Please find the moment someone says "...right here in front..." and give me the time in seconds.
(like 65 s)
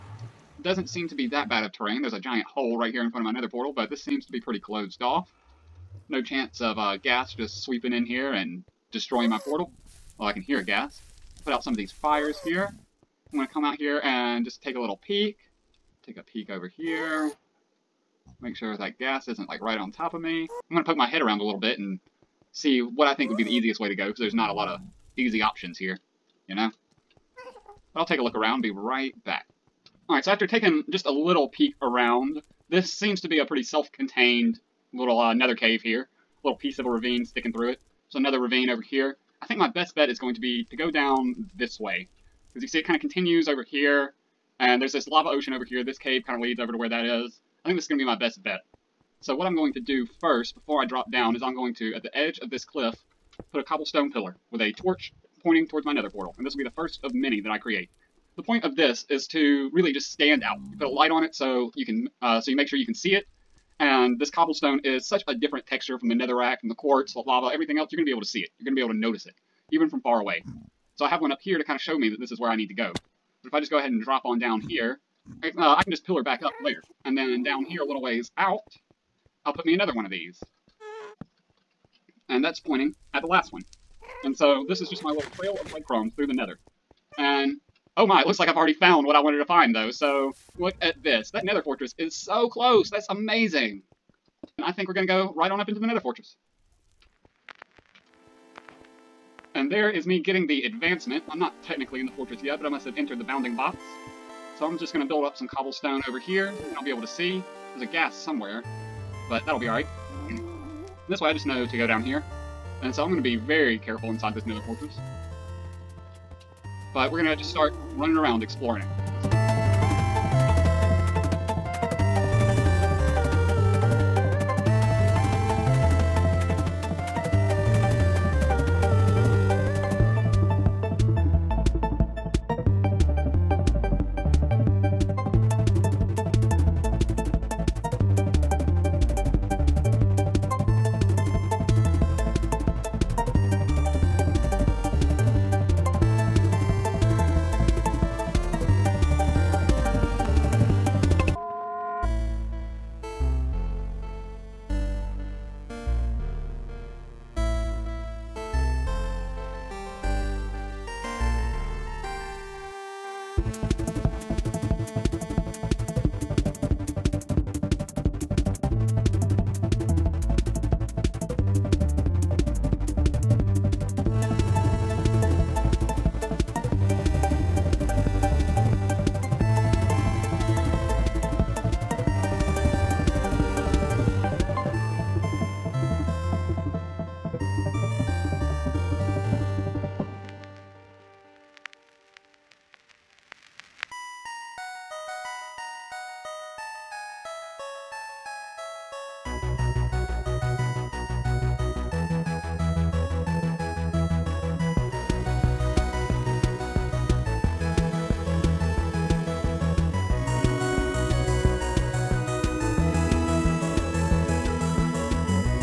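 2 s.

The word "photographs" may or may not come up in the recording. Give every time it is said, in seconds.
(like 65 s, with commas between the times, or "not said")
not said.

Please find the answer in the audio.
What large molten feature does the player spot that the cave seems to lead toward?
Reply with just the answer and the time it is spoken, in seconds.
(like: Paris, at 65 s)
Lava ocean, at 45 s.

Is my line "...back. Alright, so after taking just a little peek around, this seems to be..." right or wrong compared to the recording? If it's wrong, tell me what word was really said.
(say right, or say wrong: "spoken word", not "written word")
right.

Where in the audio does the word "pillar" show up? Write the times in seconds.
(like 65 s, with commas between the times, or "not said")
54 s, 76 s.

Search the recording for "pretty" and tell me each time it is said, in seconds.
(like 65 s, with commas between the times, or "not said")
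4 s, 33 s.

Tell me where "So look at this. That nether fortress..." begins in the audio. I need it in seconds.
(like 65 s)
89 s.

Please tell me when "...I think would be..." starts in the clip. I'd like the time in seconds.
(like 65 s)
23 s.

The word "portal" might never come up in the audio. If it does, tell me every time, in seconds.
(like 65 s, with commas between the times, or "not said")
3 s, 9 s, 56 s.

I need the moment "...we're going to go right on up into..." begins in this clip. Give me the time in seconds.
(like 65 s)
94 s.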